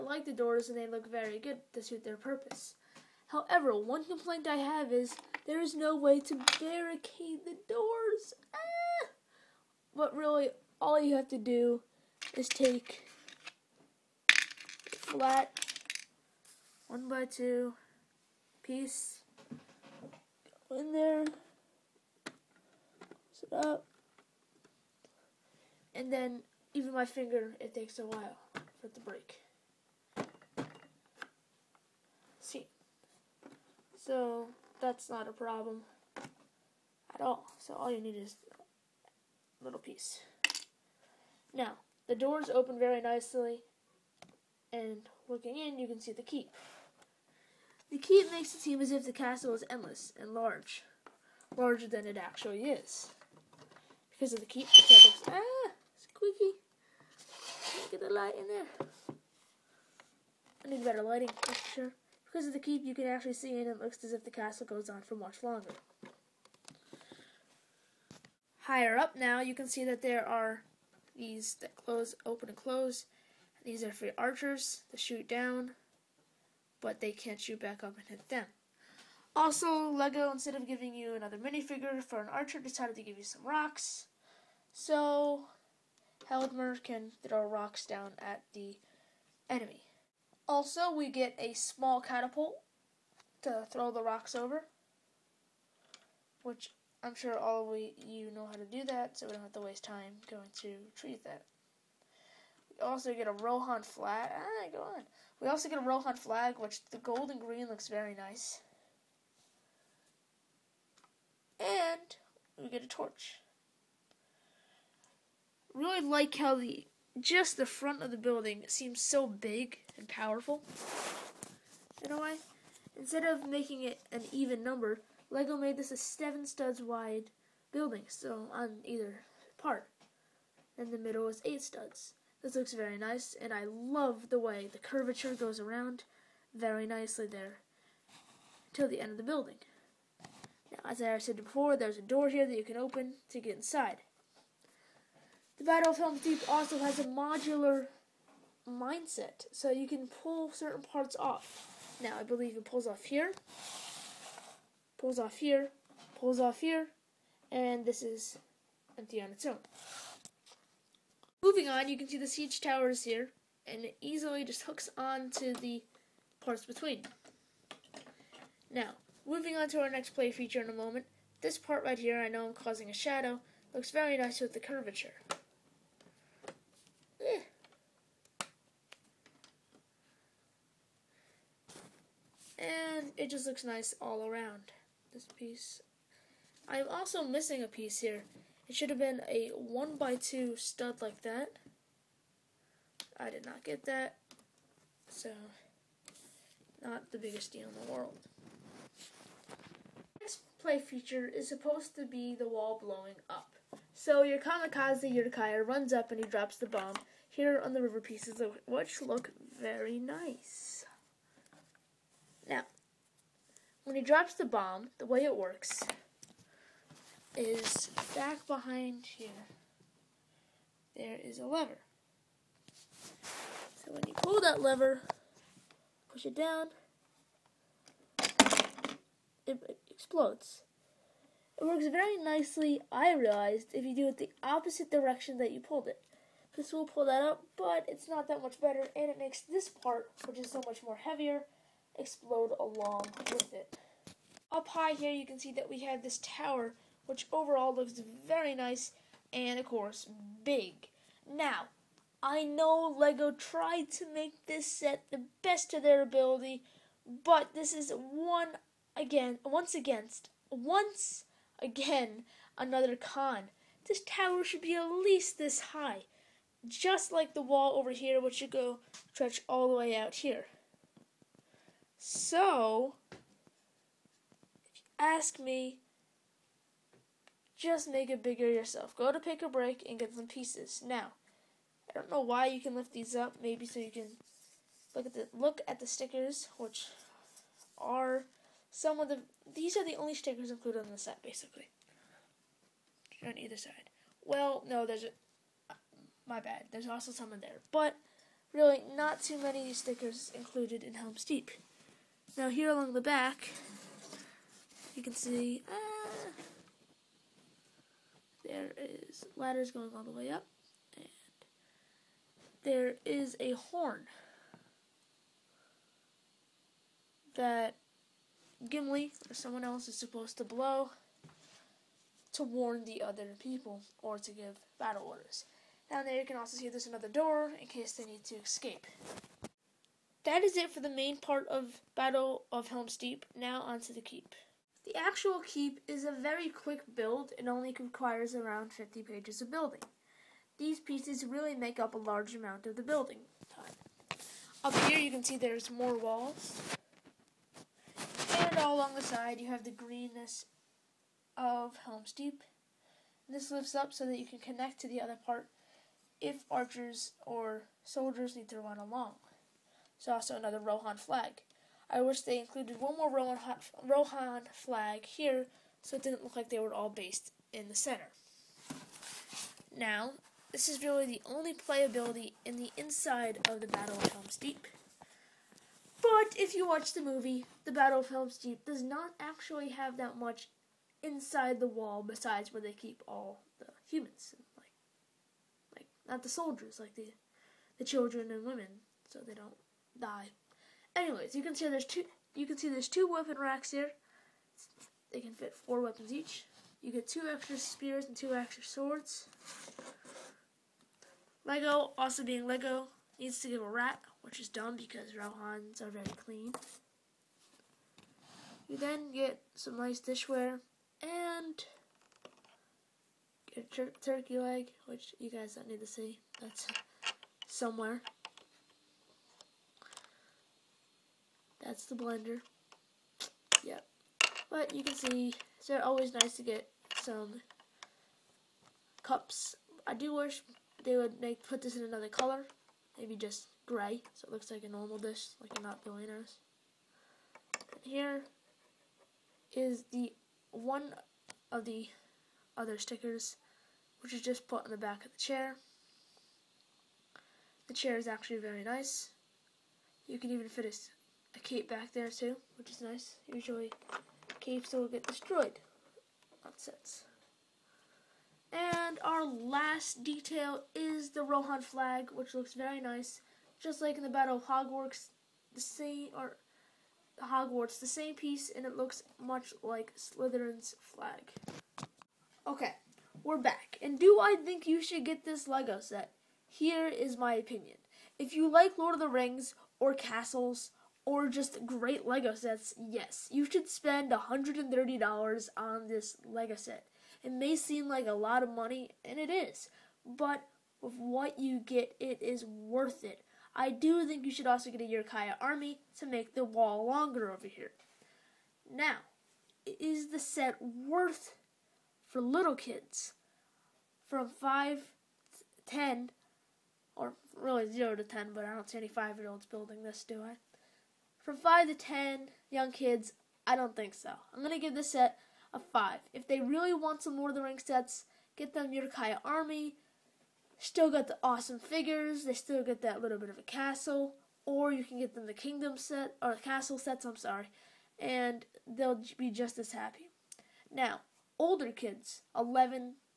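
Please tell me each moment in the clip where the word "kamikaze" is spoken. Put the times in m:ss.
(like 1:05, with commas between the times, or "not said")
3:24.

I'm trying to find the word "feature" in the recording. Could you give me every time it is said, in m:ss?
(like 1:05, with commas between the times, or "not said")
2:50, 3:20.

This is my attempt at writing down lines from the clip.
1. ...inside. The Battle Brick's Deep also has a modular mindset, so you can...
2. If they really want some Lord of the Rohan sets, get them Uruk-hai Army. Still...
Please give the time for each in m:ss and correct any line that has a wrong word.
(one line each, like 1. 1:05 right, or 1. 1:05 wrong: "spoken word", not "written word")
1. 2:23 wrong: "Helm", not "Brick"
2. 8:36 wrong: "Rings", not "Rohan".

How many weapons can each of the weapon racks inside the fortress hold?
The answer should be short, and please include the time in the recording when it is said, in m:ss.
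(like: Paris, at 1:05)
4, at 6:35.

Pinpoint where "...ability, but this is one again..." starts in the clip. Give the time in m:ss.
4:16.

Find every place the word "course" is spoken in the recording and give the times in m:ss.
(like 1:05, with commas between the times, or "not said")
4:09.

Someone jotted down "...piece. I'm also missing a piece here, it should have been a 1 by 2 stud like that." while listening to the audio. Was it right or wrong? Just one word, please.
right.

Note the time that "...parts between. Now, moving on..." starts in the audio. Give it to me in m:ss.
2:46.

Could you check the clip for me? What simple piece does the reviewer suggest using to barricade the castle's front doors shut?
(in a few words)
flat one by two.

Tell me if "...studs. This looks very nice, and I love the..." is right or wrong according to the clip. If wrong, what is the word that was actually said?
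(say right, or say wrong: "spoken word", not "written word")
right.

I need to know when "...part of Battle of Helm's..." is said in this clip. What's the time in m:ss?
5:31.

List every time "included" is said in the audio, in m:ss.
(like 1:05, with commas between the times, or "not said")
4:50, 5:00, 6:02.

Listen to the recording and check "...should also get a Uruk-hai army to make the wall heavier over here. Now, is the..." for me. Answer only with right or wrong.
wrong.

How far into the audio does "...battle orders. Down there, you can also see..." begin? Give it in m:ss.
5:24.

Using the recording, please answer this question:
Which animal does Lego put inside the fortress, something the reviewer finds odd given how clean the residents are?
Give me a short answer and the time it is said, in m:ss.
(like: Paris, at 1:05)
rat, at 6:43.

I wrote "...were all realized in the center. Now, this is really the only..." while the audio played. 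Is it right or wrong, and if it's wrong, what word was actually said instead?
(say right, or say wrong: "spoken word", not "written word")
wrong: "based", not "realized".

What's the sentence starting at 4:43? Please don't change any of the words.
Maybe so you can look at the look at the stickers, which are some of the.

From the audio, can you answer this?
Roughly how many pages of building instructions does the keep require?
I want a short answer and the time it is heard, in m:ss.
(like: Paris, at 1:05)
50, at 5:38.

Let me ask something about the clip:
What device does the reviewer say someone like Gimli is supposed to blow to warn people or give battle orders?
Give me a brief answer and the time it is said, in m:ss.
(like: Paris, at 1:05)
a horn, at 5:13.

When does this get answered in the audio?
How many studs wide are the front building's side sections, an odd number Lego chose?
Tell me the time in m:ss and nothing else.
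2:05.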